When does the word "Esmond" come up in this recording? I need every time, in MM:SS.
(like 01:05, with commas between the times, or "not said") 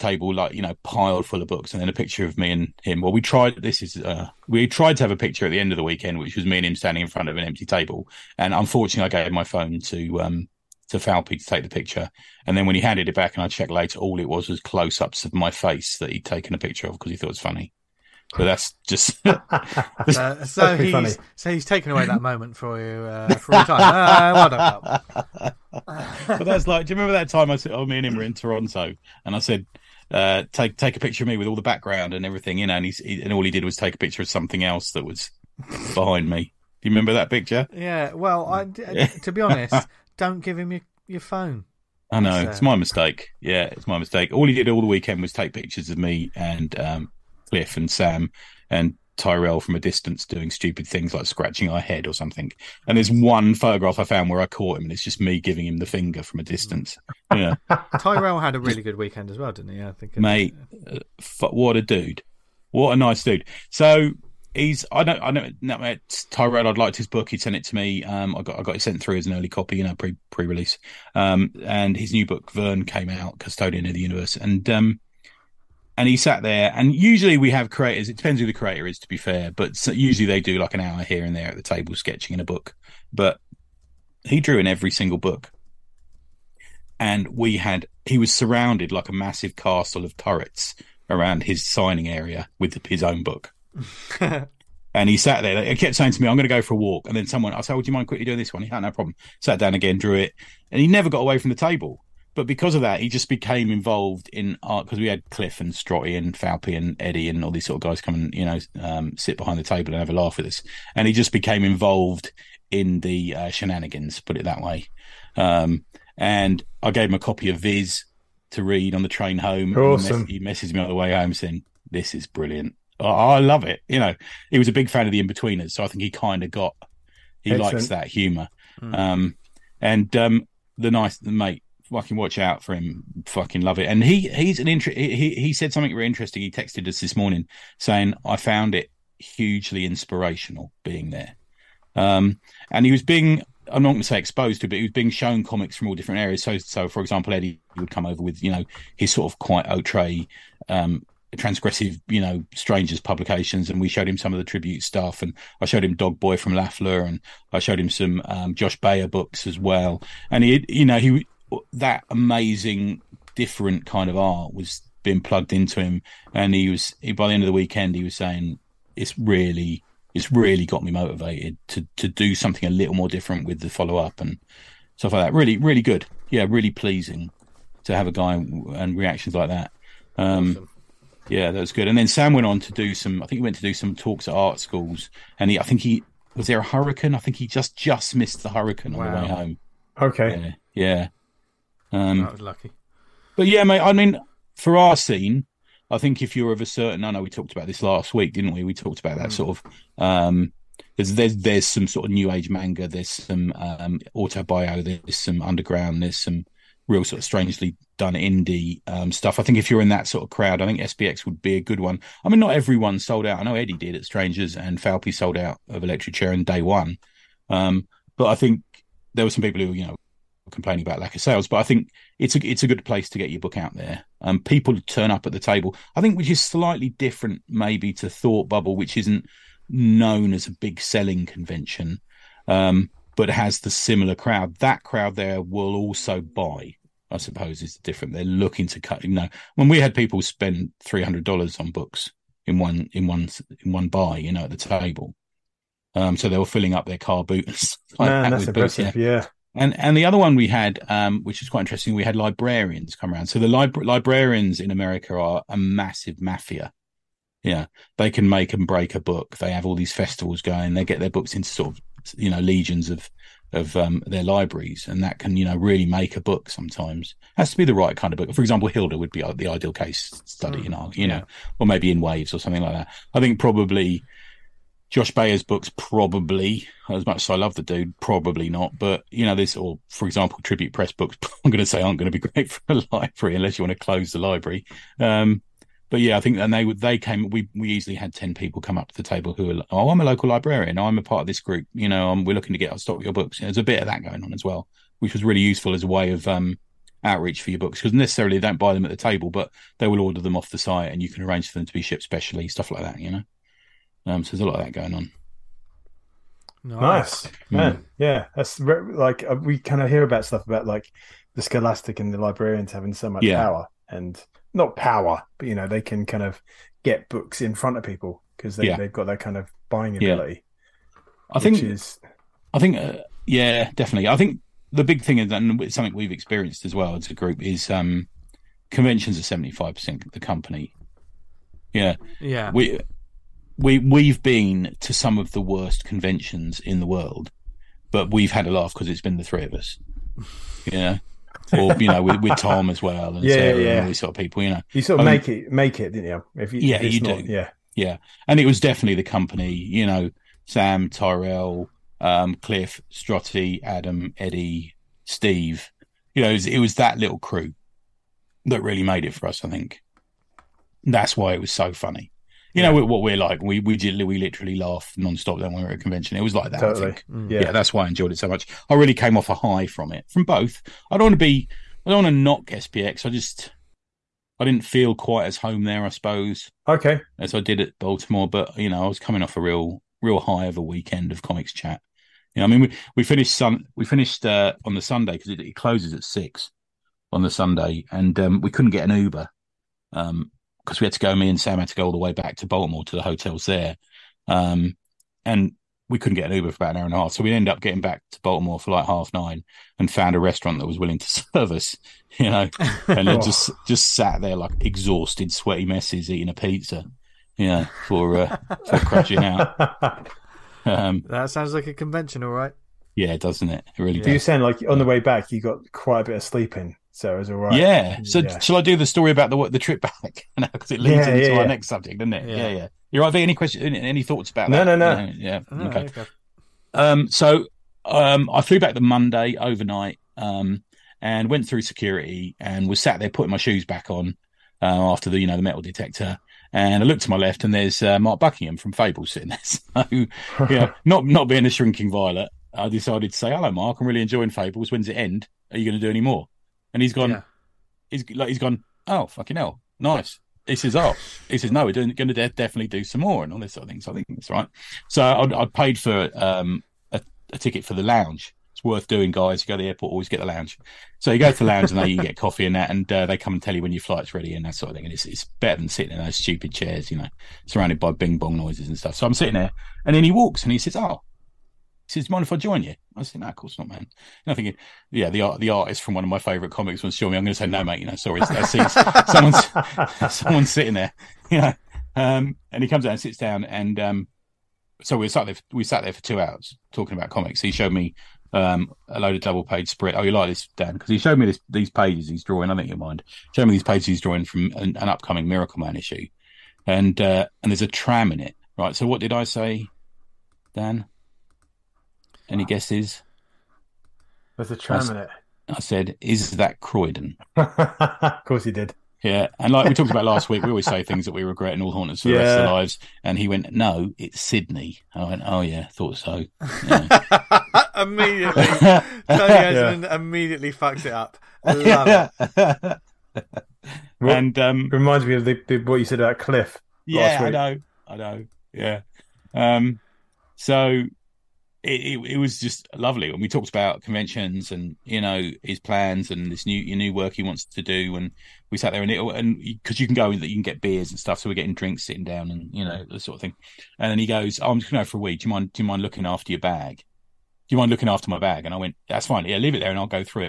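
08:39.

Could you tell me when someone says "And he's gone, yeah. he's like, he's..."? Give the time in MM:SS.
07:26.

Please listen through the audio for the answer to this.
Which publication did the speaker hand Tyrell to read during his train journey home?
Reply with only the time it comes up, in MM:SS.
01:57.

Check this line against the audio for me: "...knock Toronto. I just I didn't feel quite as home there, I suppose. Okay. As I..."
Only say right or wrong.
wrong.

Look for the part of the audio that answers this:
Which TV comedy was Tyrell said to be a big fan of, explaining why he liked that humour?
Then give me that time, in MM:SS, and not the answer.
02:05.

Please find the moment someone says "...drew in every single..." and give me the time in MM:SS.
01:24.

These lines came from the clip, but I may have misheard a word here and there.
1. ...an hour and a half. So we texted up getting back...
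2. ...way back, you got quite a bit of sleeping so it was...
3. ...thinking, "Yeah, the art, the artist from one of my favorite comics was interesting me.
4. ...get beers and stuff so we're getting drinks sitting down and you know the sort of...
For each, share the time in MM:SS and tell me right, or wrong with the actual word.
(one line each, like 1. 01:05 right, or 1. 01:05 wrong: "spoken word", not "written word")
1. 06:36 wrong: "ended", not "texted"
2. 06:54 right
3. 07:54 wrong: "showing", not "interesting"
4. 09:00 right.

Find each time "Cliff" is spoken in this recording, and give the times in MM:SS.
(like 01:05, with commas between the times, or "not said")
00:47, 01:45, 05:52, 08:46.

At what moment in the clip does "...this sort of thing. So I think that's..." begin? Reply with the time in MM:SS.
07:33.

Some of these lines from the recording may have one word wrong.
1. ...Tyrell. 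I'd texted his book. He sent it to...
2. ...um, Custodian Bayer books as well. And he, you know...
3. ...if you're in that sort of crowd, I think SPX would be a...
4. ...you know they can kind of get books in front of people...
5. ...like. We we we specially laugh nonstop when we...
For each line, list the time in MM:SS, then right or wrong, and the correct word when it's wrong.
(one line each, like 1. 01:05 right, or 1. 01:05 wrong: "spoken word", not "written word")
1. 01:06 wrong: "liked", not "texted"
2. 02:38 wrong: "Josh", not "Custodian"
3. 03:29 right
4. 05:15 right
5. 06:03 wrong: "literally", not "specially".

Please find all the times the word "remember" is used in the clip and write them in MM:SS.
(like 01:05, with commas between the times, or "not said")
00:26, 00:36.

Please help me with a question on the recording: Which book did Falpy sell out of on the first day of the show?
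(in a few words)
Electric Chair.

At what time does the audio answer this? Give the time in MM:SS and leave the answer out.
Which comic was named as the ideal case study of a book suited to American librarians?
04:28.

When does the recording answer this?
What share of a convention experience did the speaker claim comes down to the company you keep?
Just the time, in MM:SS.
05:29.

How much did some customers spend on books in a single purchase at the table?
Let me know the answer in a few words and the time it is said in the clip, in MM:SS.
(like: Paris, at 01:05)
$300, at 04:00.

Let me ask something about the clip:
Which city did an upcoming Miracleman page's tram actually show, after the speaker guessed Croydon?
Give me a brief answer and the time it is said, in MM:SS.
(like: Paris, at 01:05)
Sydney, at 08:34.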